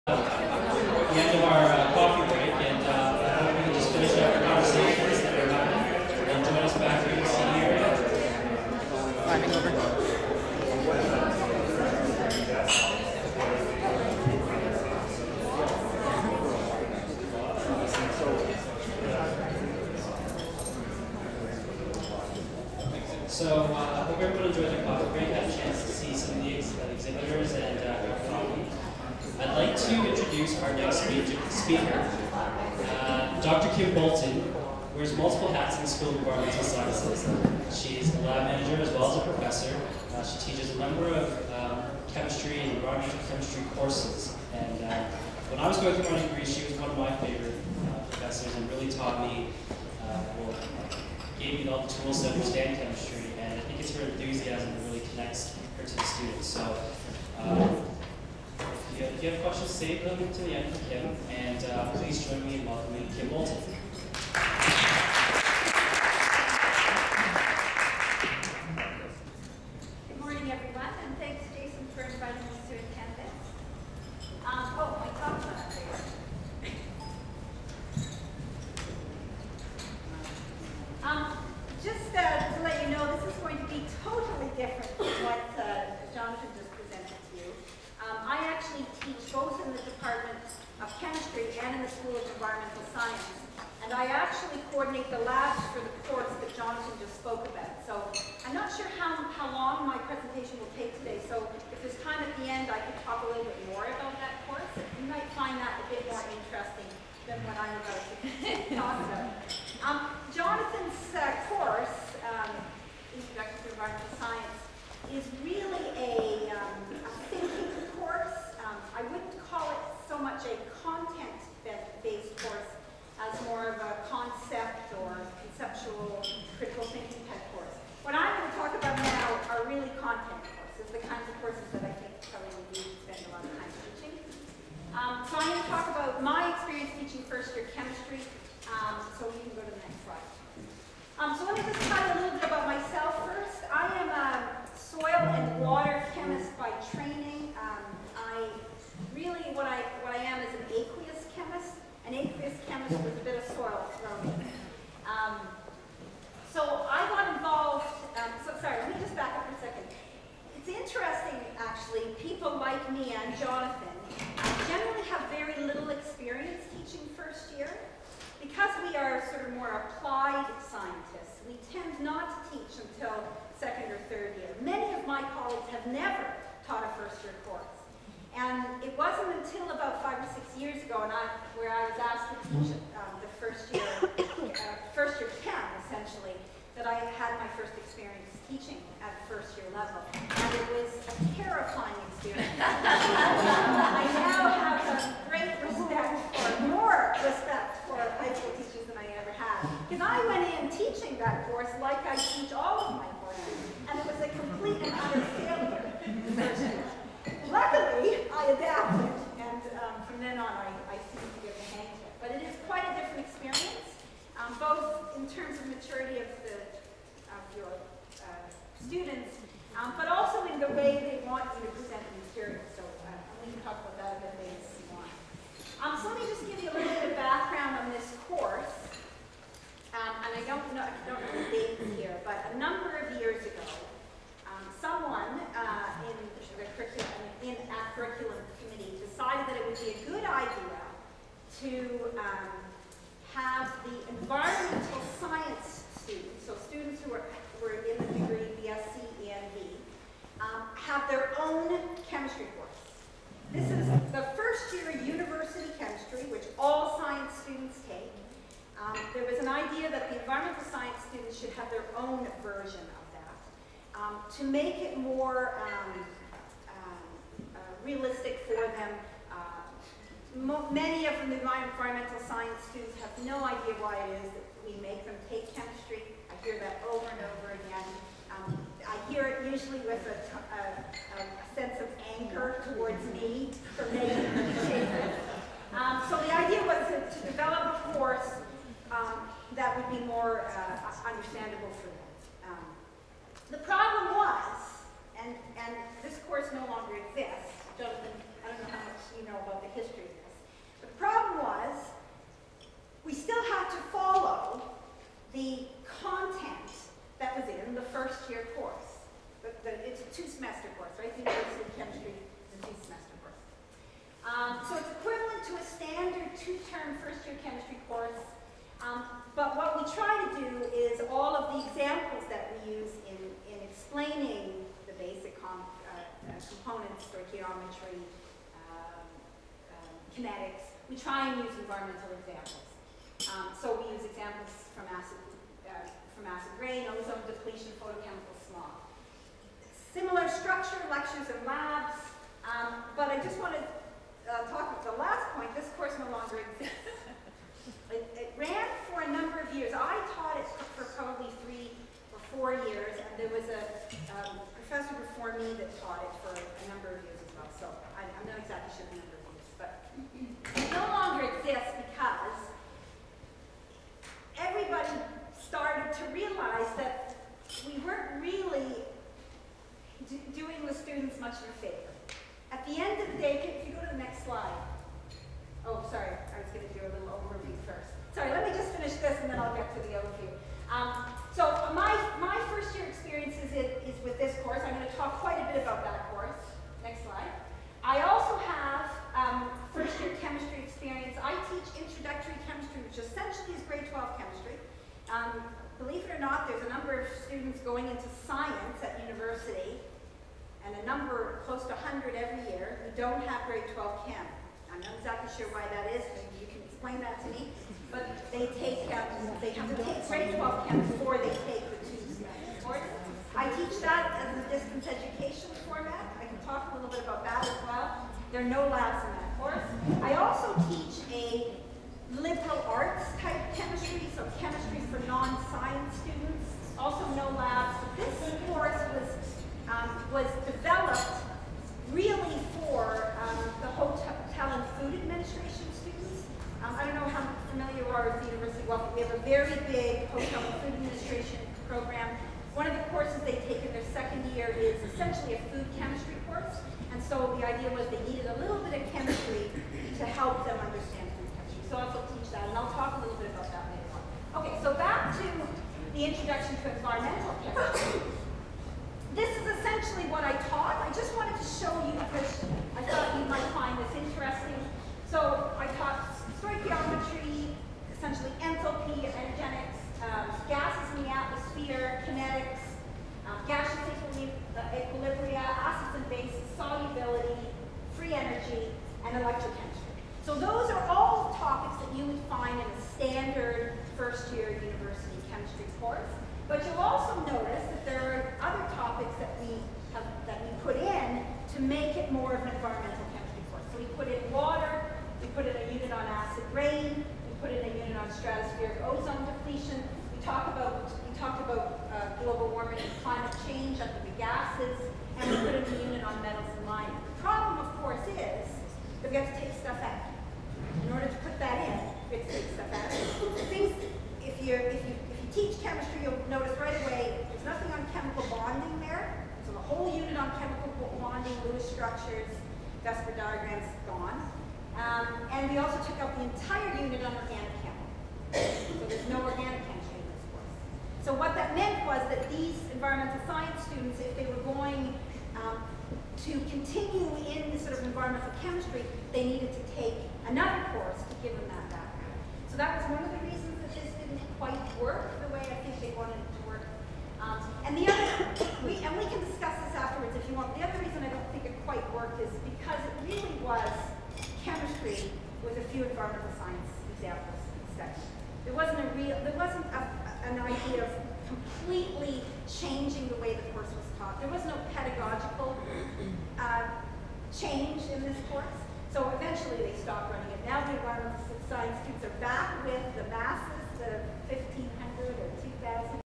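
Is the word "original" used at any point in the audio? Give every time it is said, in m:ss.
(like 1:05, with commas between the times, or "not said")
not said.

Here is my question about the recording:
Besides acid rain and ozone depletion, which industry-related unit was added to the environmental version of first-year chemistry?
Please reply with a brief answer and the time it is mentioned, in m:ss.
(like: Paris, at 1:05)
metals and mining, at 8:26.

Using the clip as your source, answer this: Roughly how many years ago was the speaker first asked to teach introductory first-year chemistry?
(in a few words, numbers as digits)
five or six years.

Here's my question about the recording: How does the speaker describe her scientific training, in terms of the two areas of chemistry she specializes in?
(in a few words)
soil and water chemist.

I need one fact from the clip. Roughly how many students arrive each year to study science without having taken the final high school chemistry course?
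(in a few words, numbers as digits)
close to 100.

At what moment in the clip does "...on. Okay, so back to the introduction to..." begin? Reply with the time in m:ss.
7:33.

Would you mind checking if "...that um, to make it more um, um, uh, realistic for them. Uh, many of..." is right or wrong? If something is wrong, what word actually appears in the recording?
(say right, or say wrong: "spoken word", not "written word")
right.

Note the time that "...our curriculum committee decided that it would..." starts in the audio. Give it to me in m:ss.
3:57.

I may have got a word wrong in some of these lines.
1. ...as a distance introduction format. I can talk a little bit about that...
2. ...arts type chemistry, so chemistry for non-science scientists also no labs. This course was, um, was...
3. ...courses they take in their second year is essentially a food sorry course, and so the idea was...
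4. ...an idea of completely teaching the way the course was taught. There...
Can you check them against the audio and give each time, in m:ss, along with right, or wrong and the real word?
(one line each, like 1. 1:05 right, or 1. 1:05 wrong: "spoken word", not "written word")
1. 6:54 wrong: "education", not "introduction"
2. 7:02 wrong: "students", not "scientists"
3. 7:22 wrong: "chemistry", not "sorry"
4. 9:20 wrong: "changing", not "teaching".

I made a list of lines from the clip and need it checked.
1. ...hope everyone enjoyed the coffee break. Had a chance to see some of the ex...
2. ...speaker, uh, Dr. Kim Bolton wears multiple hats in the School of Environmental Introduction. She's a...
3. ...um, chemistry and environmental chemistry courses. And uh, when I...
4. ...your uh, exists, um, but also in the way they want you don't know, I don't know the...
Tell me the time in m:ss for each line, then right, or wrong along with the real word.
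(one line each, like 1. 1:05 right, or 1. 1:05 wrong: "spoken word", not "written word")
1. 0:24 right
2. 0:31 wrong: "Sciences", not "Introduction"
3. 0:41 right
4. 3:37 wrong: "students", not "exists".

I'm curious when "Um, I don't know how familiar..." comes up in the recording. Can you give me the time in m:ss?
7:16.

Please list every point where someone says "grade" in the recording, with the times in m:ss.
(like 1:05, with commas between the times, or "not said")
6:43, 6:50.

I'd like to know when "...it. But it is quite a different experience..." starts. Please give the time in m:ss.
3:32.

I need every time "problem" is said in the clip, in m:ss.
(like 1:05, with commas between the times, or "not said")
4:53, 5:00.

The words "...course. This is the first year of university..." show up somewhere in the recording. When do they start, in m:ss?
4:12.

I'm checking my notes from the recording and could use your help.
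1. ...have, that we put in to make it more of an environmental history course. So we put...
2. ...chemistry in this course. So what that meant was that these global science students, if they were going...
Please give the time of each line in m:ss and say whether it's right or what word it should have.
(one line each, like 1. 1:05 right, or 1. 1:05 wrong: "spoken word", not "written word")
1. 8:09 wrong: "chemistry", not "history"
2. 8:49 wrong: "environmental", not "global".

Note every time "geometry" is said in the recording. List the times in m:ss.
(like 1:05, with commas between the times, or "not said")
5:27.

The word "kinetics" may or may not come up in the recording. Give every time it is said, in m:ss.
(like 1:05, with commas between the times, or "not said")
5:30, 7:52.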